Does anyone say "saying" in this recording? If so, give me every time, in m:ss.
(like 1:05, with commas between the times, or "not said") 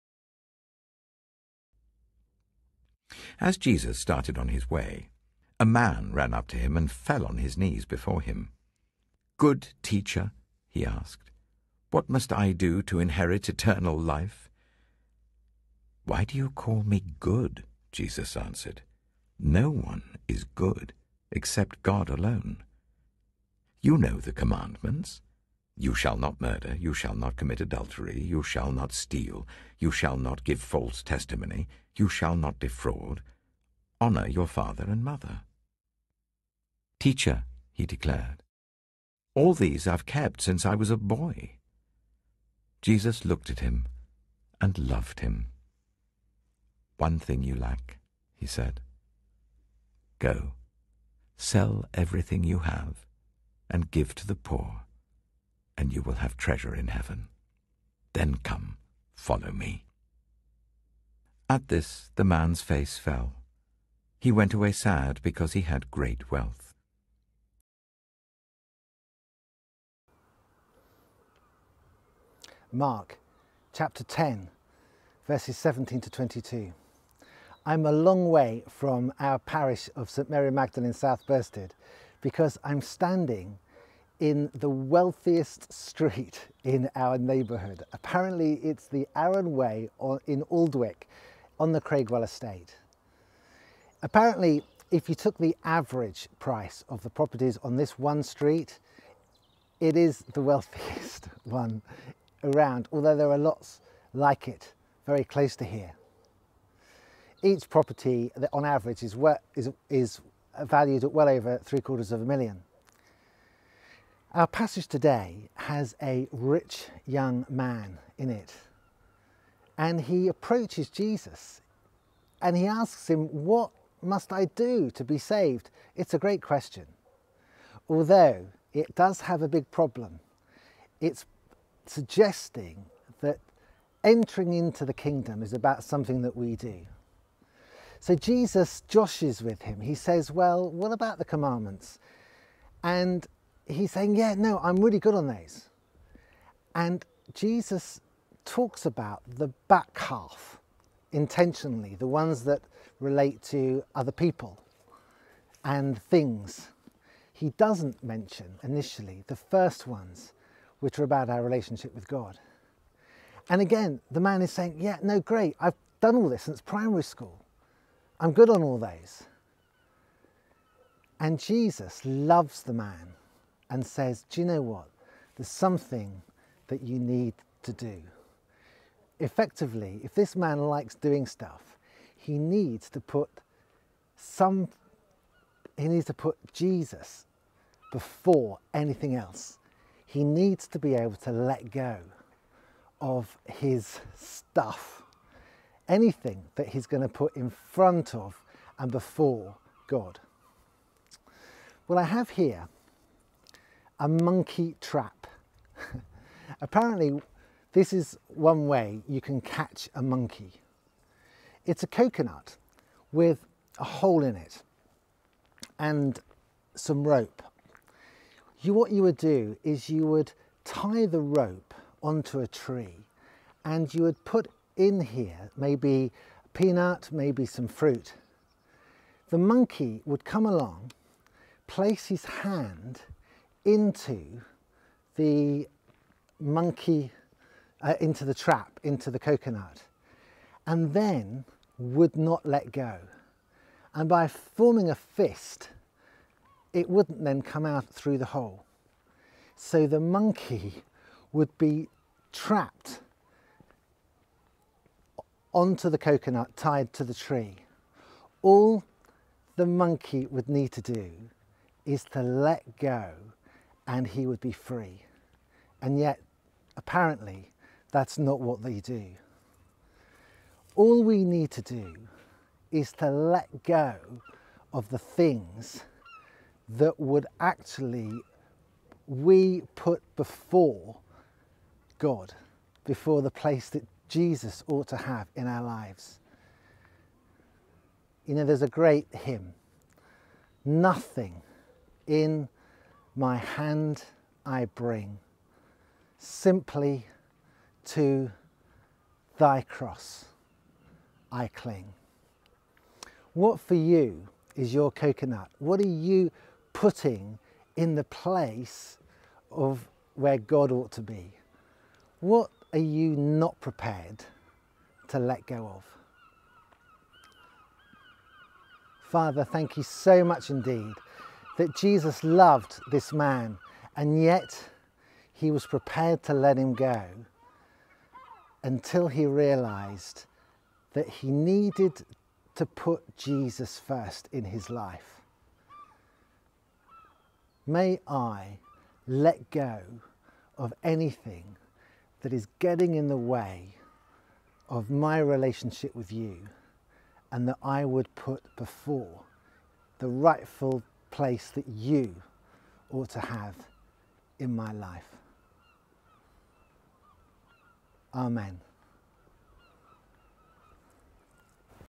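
2:23, 2:44.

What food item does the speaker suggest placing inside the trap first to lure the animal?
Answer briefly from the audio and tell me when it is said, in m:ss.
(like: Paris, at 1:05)
a peanut, at 3:46.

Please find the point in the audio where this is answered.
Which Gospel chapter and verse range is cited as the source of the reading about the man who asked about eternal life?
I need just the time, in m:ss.
1:12.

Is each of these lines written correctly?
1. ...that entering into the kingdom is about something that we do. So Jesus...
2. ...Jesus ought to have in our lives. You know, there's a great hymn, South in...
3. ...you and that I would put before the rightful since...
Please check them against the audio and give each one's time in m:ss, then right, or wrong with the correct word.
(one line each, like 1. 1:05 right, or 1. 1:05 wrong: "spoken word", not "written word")
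1. 2:13 right
2. 4:44 wrong: "Nothing", not "South"
3. 5:46 wrong: "place", not "since".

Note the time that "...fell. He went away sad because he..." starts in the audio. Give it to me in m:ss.
1:02.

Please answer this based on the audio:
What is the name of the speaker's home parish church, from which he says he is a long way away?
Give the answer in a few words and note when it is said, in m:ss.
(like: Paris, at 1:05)
St Mary Magdalene, at 1:20.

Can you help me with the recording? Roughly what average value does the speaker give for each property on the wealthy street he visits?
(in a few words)
over three quarters of a million.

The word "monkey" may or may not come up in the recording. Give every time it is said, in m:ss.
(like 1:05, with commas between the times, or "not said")
3:24, 3:30, 3:49, 3:56, 4:09, 4:19.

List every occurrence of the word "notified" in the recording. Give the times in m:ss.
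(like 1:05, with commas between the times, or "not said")
not said.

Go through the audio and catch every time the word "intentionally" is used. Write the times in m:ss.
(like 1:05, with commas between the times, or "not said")
2:31.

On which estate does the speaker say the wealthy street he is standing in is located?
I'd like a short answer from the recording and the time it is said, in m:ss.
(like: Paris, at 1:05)
Craigweil estate, at 1:31.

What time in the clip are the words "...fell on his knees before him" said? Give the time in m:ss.
0:06.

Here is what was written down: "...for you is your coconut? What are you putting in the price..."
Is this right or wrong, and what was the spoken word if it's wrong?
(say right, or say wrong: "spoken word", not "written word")
wrong: "place", not "price".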